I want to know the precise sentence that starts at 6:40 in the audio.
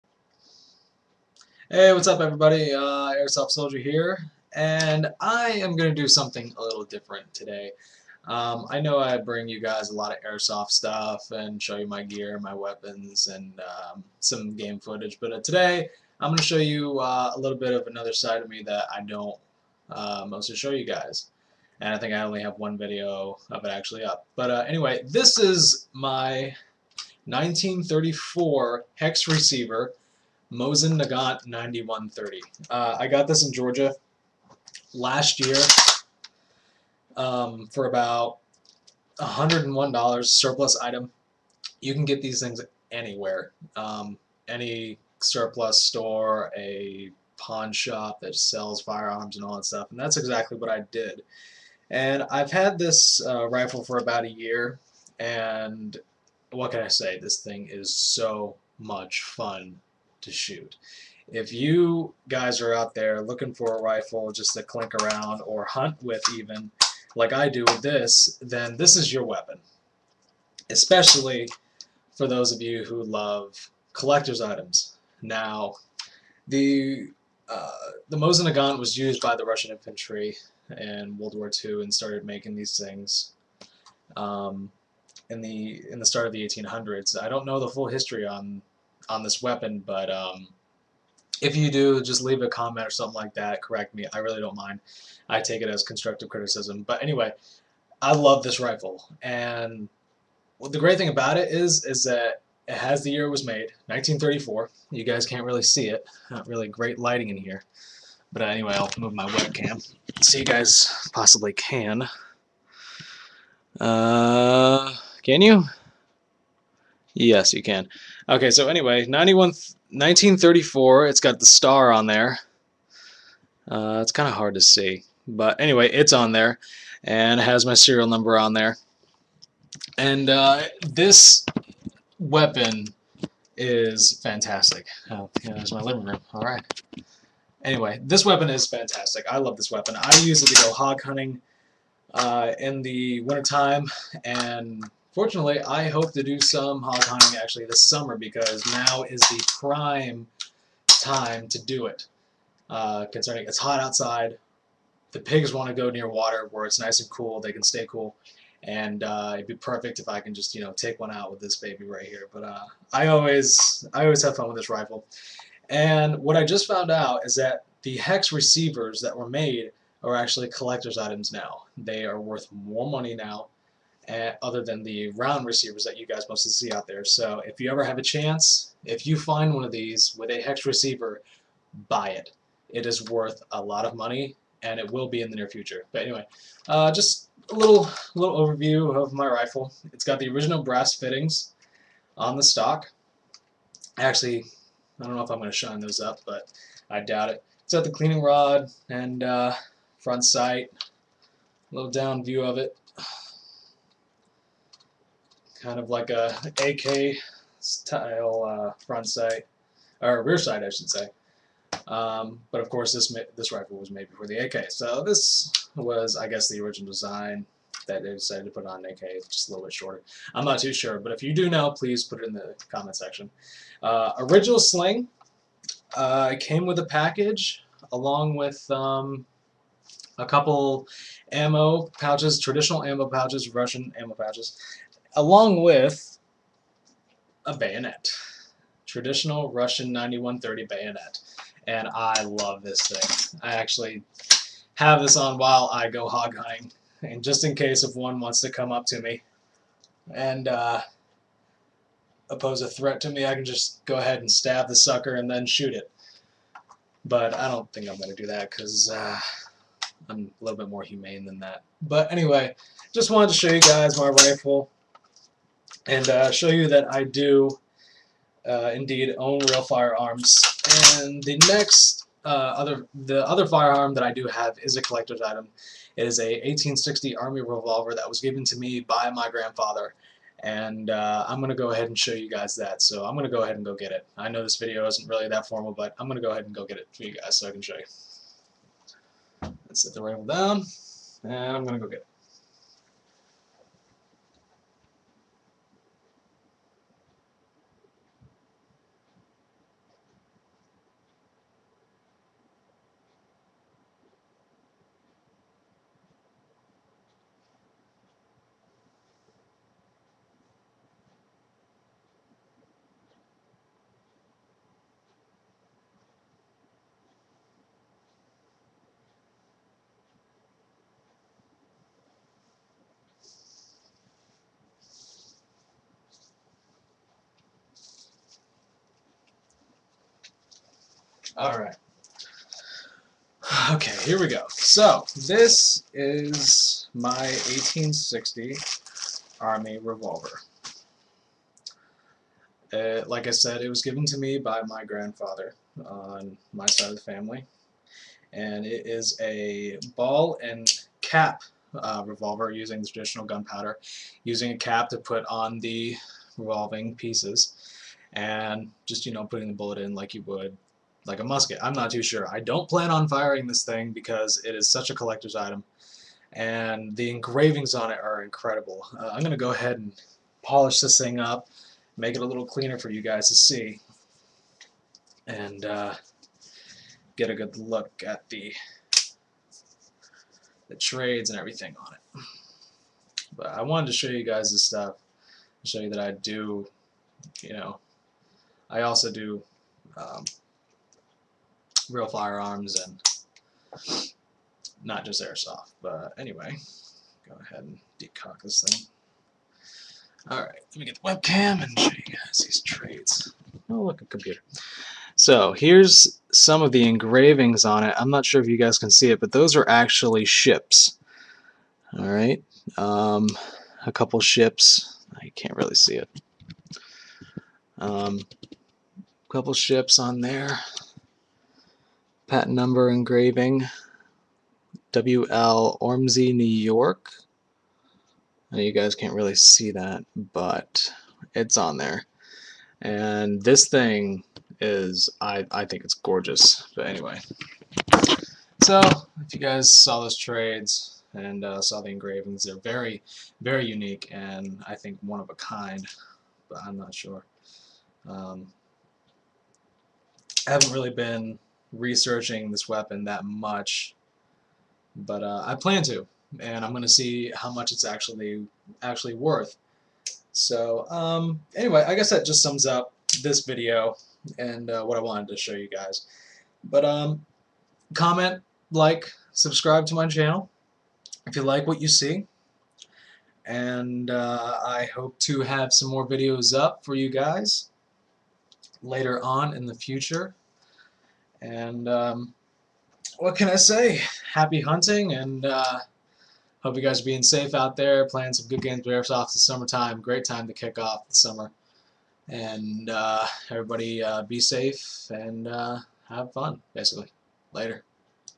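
Alright, let me get the webcam and show you guys these trades.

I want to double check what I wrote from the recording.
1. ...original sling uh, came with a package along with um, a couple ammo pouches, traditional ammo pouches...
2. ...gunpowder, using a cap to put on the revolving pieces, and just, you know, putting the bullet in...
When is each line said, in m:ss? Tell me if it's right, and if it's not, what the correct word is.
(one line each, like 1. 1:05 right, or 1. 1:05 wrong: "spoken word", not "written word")
1. 3:44 right
2. 5:53 right.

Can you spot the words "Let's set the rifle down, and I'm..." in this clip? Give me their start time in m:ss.
4:49.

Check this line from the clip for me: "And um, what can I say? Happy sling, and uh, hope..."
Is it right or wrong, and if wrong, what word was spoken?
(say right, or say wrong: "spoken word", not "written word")
wrong: "hunting", not "sling".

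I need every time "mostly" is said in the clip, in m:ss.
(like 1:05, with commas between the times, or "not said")
0:20, 2:56.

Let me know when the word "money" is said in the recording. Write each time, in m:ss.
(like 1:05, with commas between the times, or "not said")
2:52, 3:03.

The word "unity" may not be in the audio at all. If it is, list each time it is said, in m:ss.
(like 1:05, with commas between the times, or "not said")
not said.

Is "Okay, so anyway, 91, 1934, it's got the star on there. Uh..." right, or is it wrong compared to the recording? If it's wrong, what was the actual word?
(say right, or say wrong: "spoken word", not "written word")
right.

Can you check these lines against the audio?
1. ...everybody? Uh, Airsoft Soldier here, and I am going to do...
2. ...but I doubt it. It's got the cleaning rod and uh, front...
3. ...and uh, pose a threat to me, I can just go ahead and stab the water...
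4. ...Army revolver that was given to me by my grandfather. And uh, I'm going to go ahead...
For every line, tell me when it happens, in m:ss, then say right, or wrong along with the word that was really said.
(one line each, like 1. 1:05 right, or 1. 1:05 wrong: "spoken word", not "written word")
1. 0:02 right
2. 3:16 right
3. 4:10 wrong: "sucker", not "water"
4. 4:37 right.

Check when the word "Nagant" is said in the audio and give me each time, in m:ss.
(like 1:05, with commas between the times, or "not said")
0:31, 1:18.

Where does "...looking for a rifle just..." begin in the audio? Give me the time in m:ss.
1:03.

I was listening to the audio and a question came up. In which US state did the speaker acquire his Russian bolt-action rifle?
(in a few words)
Georgia.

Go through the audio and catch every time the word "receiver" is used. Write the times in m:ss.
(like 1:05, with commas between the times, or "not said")
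0:29, 2:48, 2:55, 3:00.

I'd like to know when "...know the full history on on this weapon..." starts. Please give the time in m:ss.
1:27.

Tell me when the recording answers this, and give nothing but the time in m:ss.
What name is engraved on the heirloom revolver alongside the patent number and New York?
7:04.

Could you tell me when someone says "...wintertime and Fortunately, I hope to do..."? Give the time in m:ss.
2:23.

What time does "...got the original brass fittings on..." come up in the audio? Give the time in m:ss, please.
3:10.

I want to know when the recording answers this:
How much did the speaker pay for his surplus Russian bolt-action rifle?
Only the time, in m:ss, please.
0:39.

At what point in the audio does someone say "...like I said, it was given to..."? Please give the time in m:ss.
5:43.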